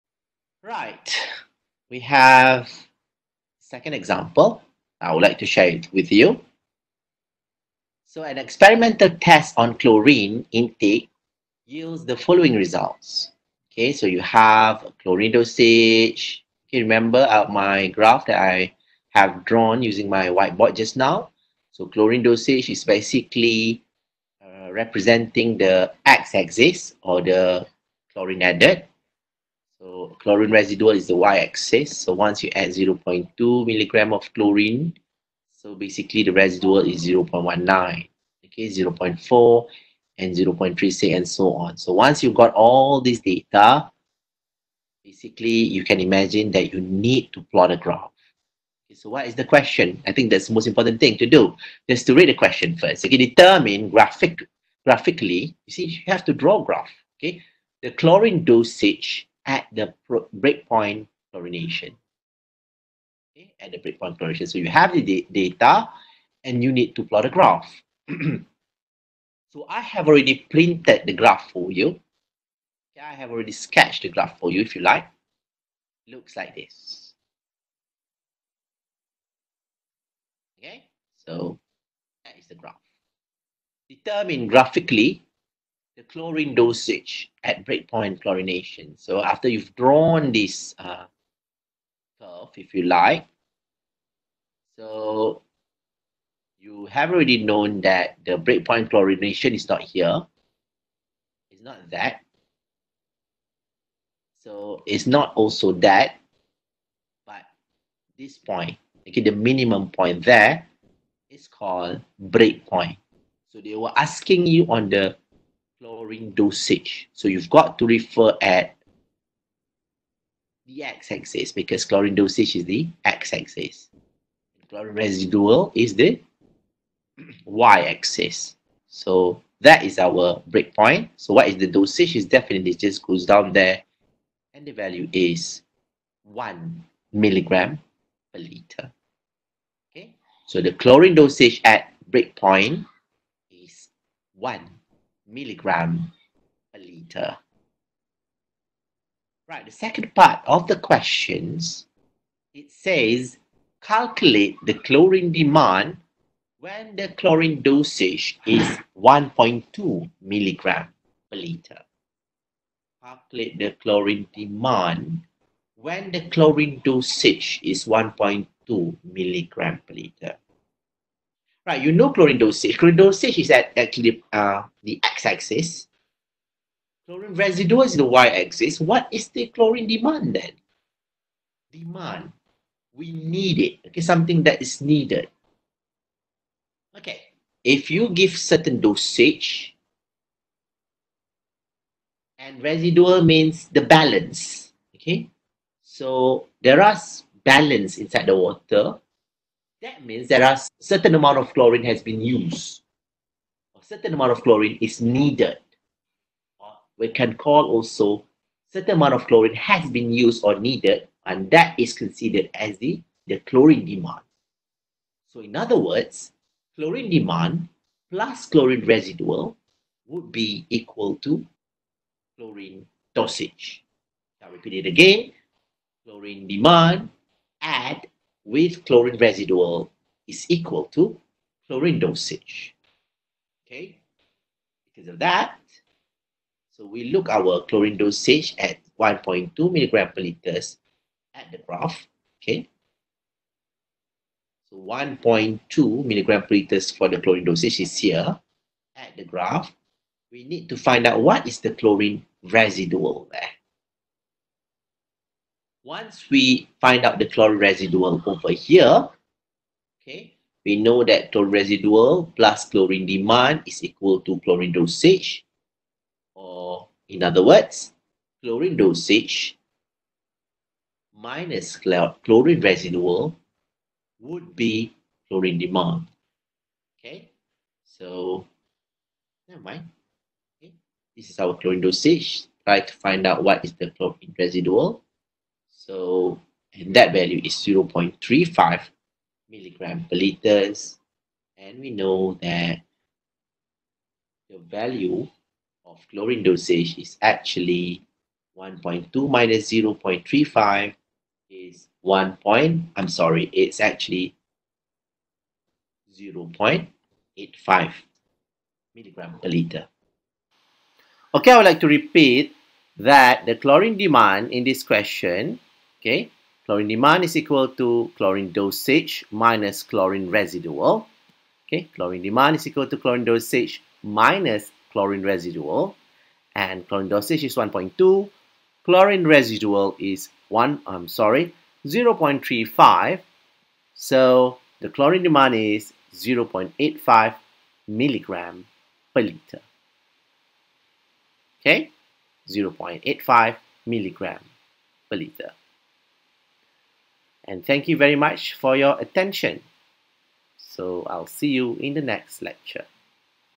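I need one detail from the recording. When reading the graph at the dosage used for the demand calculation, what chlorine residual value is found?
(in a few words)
0.35 milligram per liter.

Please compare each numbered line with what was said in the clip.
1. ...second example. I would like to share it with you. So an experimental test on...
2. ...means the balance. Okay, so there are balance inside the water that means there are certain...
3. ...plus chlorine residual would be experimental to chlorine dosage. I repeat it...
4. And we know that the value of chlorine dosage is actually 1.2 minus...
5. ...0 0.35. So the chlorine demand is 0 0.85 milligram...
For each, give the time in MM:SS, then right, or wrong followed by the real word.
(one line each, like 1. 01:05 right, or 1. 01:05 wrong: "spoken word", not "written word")
1. 00:03 right
2. 03:13 right
3. 03:38 wrong: "equal", not "experimental"
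4. 04:51 right
5. 05:31 right.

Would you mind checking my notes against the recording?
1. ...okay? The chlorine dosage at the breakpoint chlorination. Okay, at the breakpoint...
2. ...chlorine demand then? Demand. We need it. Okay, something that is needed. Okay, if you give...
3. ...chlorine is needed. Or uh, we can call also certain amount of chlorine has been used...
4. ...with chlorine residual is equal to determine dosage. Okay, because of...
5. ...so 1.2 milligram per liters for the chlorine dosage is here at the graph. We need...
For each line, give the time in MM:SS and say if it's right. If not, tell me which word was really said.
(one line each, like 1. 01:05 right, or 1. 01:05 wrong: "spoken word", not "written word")
1. 00:57 right
2. 02:59 right
3. 03:24 right
4. 03:48 wrong: "chlorine", not "determine"
5. 04:04 right.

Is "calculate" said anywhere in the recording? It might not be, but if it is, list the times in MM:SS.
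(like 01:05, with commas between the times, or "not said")
02:33, 02:43.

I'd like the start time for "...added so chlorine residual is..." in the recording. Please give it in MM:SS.
00:28.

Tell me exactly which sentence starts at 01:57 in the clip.
So you've got to refer at the x-axis because chlorine dosage is the x-axis.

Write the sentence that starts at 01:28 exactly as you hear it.
So after you've drawn this uh, curve, if you like, so you have already known that the breakpoint chlorination is not here.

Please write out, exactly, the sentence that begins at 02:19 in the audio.
Okay, so the chlorine dosage at breakpoint is 1 milligram per liter.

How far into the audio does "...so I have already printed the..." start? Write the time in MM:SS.
01:09.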